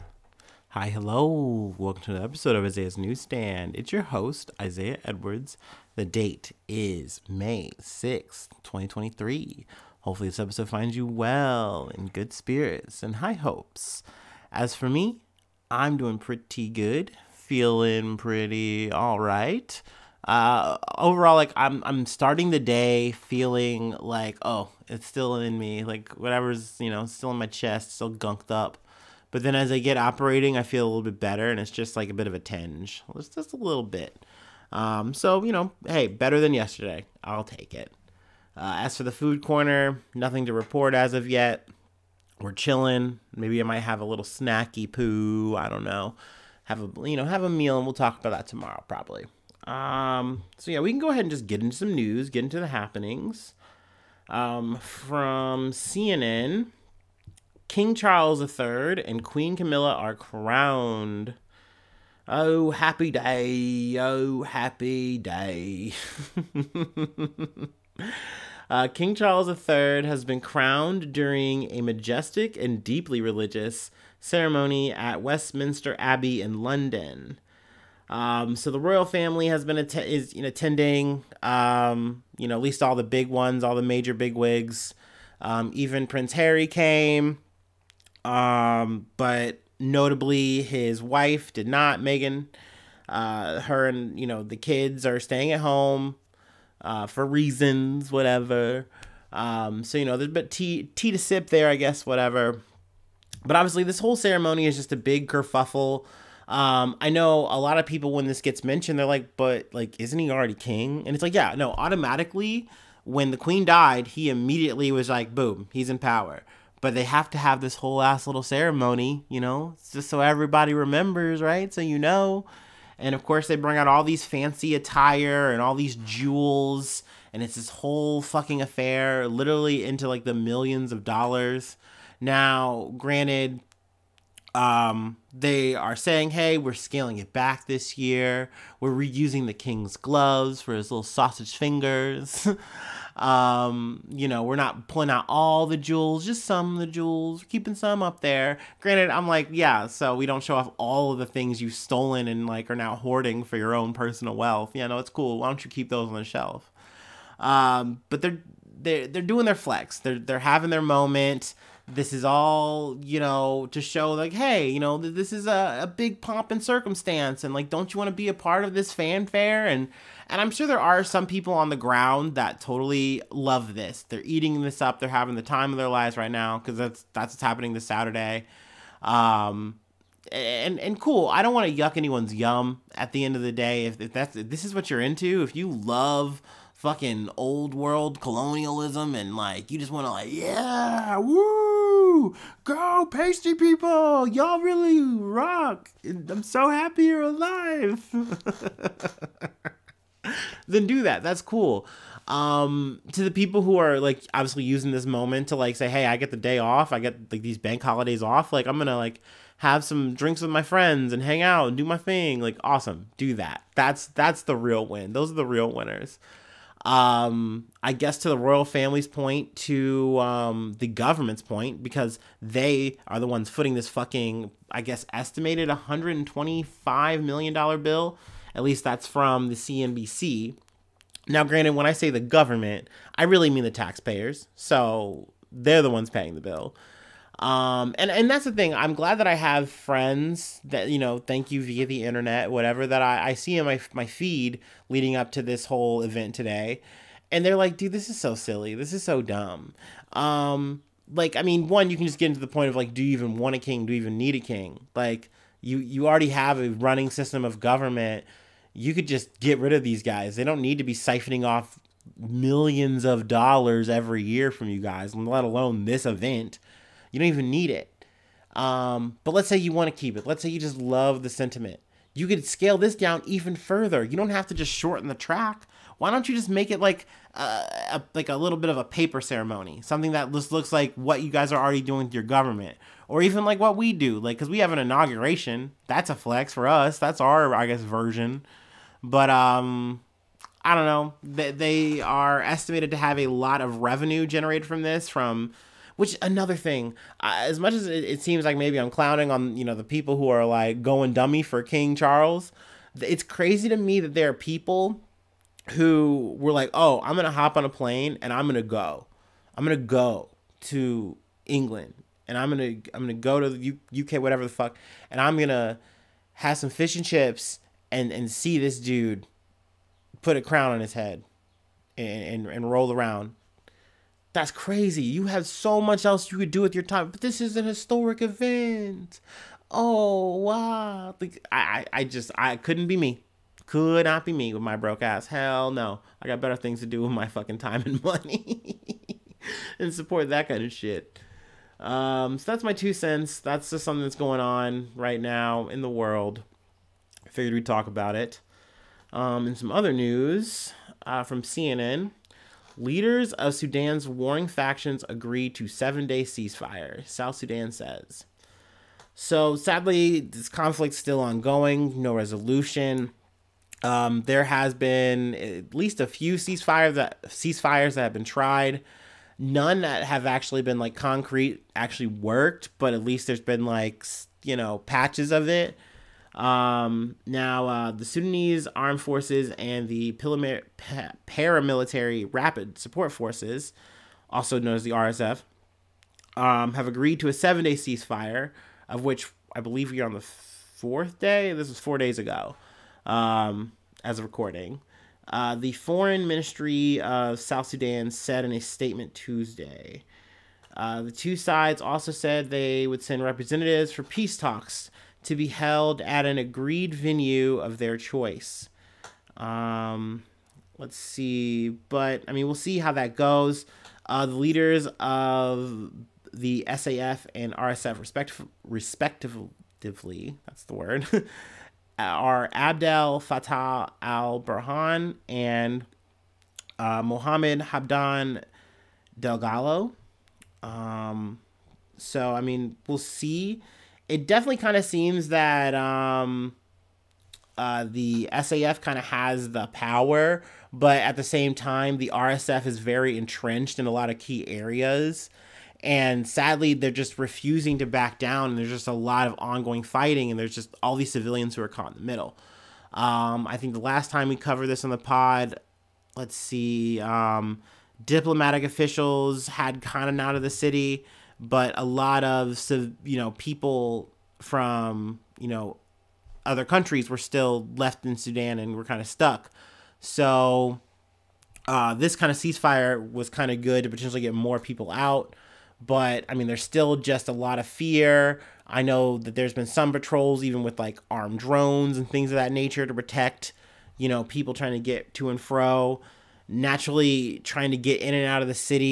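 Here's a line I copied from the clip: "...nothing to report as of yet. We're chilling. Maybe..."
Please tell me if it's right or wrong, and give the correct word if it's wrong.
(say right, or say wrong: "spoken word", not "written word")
right.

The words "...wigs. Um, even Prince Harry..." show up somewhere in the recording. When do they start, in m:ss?
1:24.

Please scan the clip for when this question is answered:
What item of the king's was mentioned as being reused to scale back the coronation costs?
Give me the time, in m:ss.
2:19.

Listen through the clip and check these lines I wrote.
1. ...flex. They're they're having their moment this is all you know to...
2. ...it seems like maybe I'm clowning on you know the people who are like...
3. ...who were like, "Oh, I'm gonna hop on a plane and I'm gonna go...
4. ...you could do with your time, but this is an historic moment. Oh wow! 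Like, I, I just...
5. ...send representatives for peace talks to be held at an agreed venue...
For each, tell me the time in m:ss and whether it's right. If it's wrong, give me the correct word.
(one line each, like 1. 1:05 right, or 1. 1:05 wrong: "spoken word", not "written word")
1. 2:39 right
2. 4:58 right
3. 5:05 right
4. 5:26 wrong: "event", not "moment"
5. 6:43 right.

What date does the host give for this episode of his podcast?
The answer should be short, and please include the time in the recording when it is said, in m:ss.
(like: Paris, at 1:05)
May 6th, 2023, at 0:07.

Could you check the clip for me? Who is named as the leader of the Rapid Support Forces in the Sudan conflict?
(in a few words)
Mohammed Hamdan Dagalo.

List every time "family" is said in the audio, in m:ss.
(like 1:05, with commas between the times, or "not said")
1:19, 3:38.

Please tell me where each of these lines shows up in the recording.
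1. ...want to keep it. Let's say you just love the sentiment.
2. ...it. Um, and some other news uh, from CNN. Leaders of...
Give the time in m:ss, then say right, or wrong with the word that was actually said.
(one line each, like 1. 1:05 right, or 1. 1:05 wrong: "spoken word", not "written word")
1. 4:29 right
2. 5:48 right.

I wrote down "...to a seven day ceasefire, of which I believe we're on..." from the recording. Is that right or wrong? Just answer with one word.
right.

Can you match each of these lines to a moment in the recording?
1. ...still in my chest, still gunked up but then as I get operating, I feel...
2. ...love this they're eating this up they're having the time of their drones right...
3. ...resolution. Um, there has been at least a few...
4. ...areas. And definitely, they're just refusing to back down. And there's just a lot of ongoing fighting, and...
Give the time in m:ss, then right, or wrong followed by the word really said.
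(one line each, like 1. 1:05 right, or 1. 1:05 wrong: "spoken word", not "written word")
1. 0:27 right
2. 2:53 wrong: "lives", not "drones"
3. 6:02 right
4. 7:24 wrong: "sadly", not "definitely".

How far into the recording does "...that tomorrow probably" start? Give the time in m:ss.
0:48.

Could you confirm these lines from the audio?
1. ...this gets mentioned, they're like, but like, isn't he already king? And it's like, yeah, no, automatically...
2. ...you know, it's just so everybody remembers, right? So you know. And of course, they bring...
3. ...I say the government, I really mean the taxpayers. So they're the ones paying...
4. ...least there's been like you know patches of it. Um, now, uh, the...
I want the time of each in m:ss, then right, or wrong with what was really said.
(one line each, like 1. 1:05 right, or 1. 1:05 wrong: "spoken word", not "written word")
1. 1:48 right
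2. 1:59 right
3. 3:51 right
4. 6:13 right.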